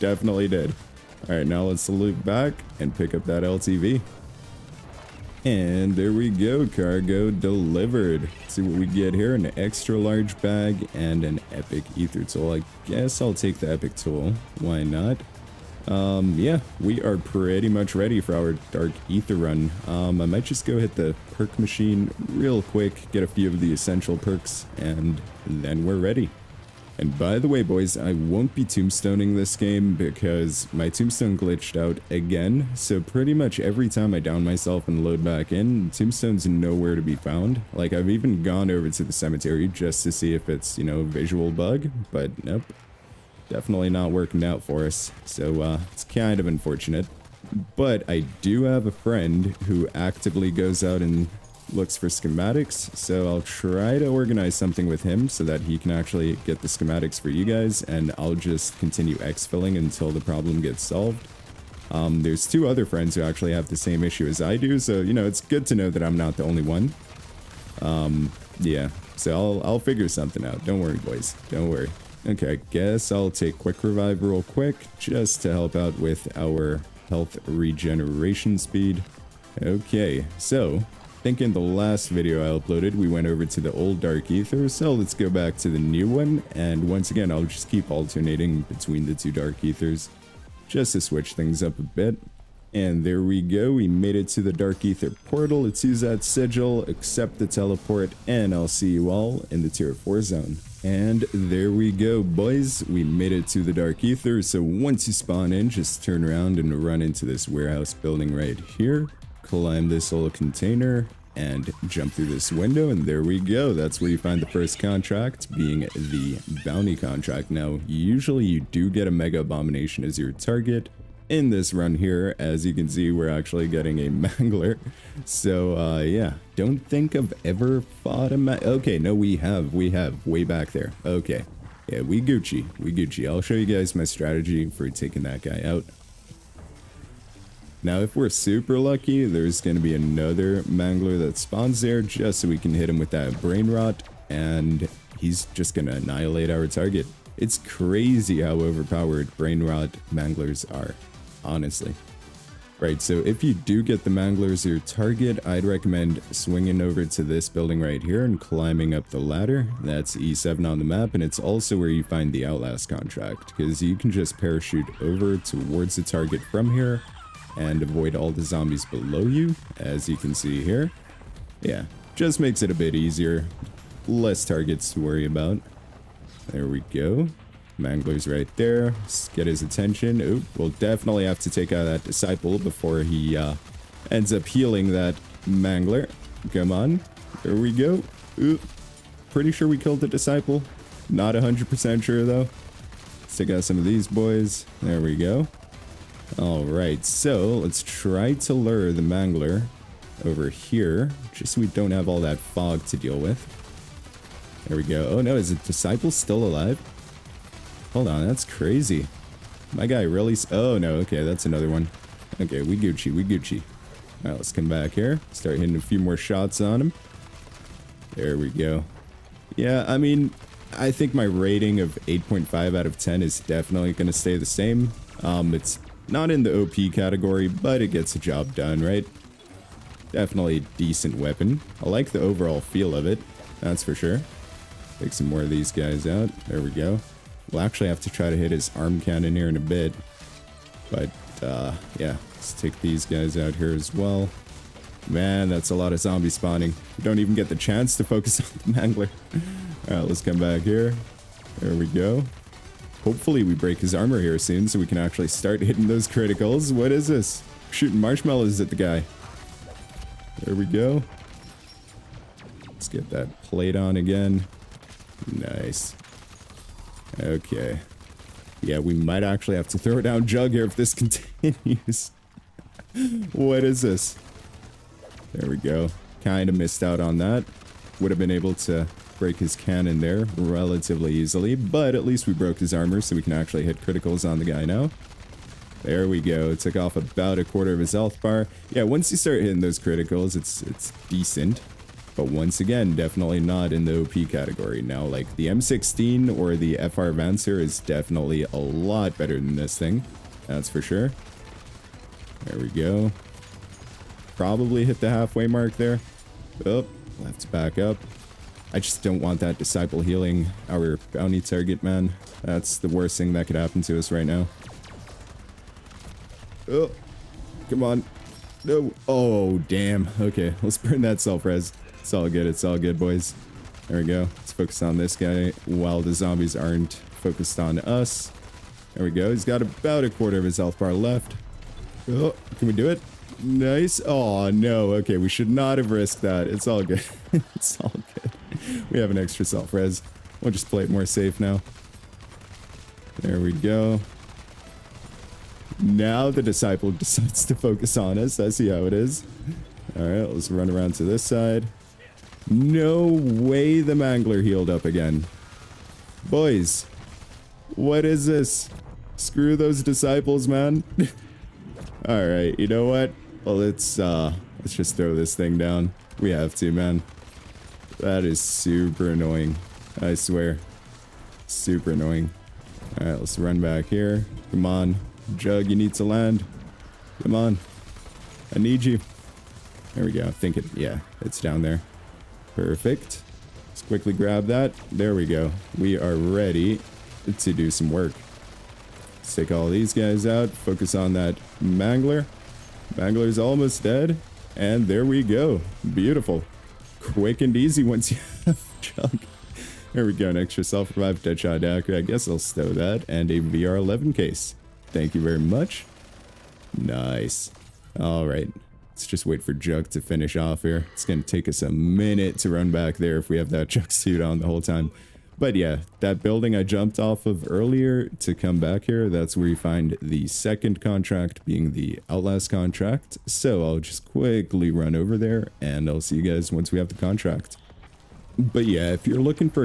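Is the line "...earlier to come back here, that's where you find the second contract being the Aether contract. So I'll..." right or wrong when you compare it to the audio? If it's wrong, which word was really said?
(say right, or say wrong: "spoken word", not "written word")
wrong: "Outlast", not "Aether".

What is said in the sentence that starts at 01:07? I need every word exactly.
Um, yeah, so I'll, I'll figure something out.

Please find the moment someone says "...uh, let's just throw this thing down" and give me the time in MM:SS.
06:03.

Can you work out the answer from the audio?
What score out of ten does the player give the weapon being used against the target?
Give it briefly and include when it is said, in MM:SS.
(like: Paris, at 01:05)
8.5, at 03:42.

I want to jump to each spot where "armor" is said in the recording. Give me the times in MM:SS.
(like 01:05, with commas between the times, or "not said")
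04:13, 04:42.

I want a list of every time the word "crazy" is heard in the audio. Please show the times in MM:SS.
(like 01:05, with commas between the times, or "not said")
02:27, 03:28.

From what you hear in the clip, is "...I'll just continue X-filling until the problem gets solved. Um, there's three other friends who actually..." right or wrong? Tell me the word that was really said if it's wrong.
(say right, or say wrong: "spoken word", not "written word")
wrong: "two", not "three".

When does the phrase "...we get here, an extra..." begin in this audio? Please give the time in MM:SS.
00:08.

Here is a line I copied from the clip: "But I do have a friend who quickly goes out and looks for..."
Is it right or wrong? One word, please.
wrong.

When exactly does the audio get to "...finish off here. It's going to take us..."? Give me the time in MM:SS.
06:50.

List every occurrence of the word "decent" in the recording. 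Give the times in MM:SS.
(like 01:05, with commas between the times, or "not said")
03:50, 04:51.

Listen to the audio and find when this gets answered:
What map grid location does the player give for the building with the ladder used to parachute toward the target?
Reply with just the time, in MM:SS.
02:40.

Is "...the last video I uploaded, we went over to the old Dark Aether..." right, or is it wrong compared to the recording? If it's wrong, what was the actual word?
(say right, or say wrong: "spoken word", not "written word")
right.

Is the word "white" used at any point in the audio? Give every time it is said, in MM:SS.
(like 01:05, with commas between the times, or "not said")
not said.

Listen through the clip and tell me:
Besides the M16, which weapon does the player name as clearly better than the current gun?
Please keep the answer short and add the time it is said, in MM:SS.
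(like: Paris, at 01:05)
FR Avancer, at 04:56.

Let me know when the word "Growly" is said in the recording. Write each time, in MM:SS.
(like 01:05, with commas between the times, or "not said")
not said.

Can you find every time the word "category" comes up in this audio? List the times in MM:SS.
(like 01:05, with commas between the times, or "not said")
03:46, 04:54.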